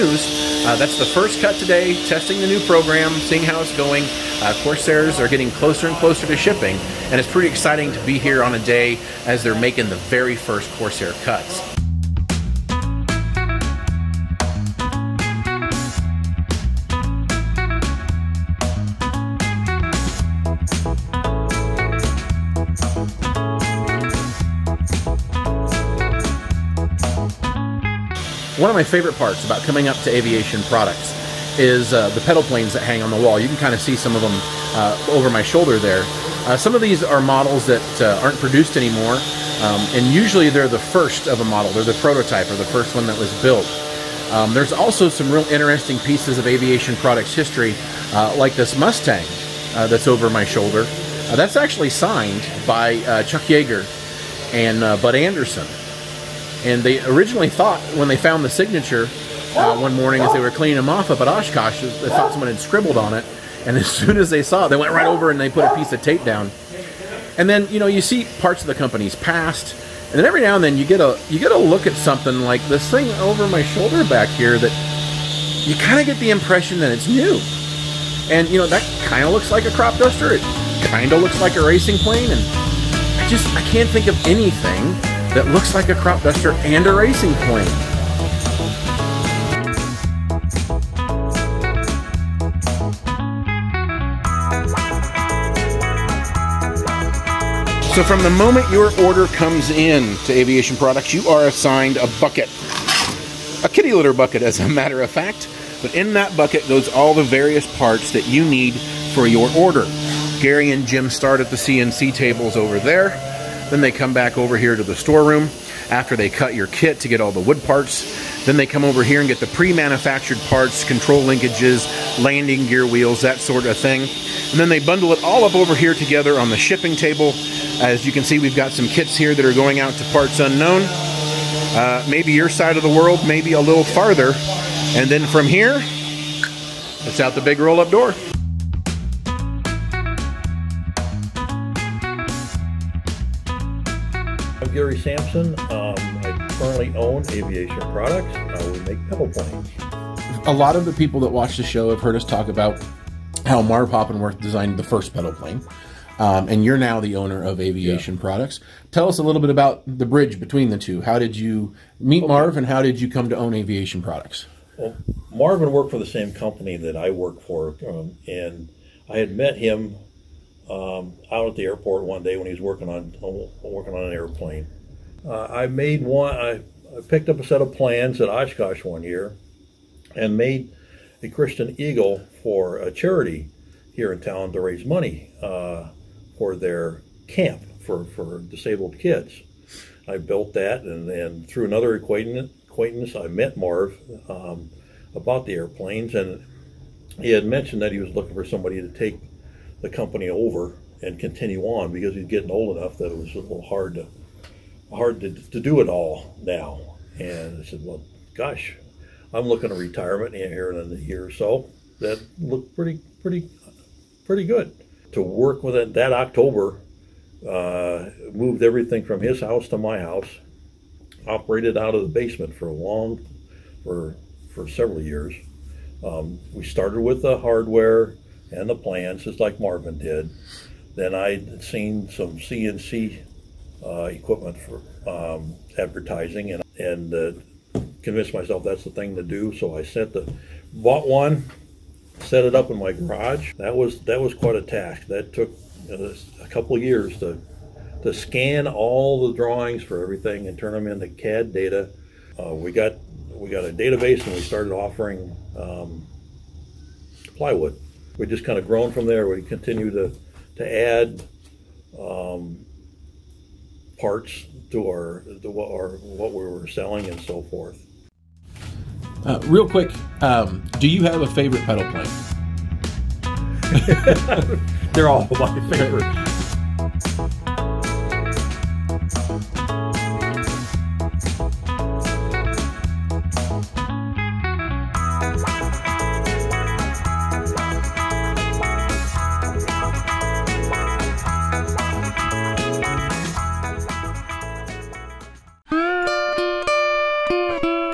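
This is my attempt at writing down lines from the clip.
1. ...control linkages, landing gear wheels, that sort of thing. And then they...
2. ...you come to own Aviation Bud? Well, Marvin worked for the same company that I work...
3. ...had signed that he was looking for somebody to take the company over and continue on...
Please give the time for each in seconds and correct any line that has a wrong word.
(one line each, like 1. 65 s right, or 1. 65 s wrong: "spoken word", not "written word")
1. 120 s right
2. 162 s wrong: "Products", not "Bud"
3. 197 s wrong: "mentioned", not "signed".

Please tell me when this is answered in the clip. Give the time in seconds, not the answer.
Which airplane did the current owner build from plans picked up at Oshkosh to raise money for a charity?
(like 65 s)
181 s.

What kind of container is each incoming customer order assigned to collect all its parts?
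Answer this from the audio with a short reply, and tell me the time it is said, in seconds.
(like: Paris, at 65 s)
Kitty litter bucket, at 103 s.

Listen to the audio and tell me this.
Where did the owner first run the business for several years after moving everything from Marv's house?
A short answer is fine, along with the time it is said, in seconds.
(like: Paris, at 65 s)
The basement, at 222 s.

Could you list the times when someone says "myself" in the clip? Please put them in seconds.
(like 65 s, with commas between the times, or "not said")
238 s.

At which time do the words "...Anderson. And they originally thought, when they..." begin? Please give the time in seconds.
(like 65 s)
55 s.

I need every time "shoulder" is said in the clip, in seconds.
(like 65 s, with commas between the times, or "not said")
35 s, 50 s, 73 s.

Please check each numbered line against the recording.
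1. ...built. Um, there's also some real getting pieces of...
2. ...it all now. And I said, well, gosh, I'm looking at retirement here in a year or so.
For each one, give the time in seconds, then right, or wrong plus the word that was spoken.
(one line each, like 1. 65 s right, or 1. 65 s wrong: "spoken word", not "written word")
1. 43 s wrong: "interesting", not "getting"
2. 205 s right.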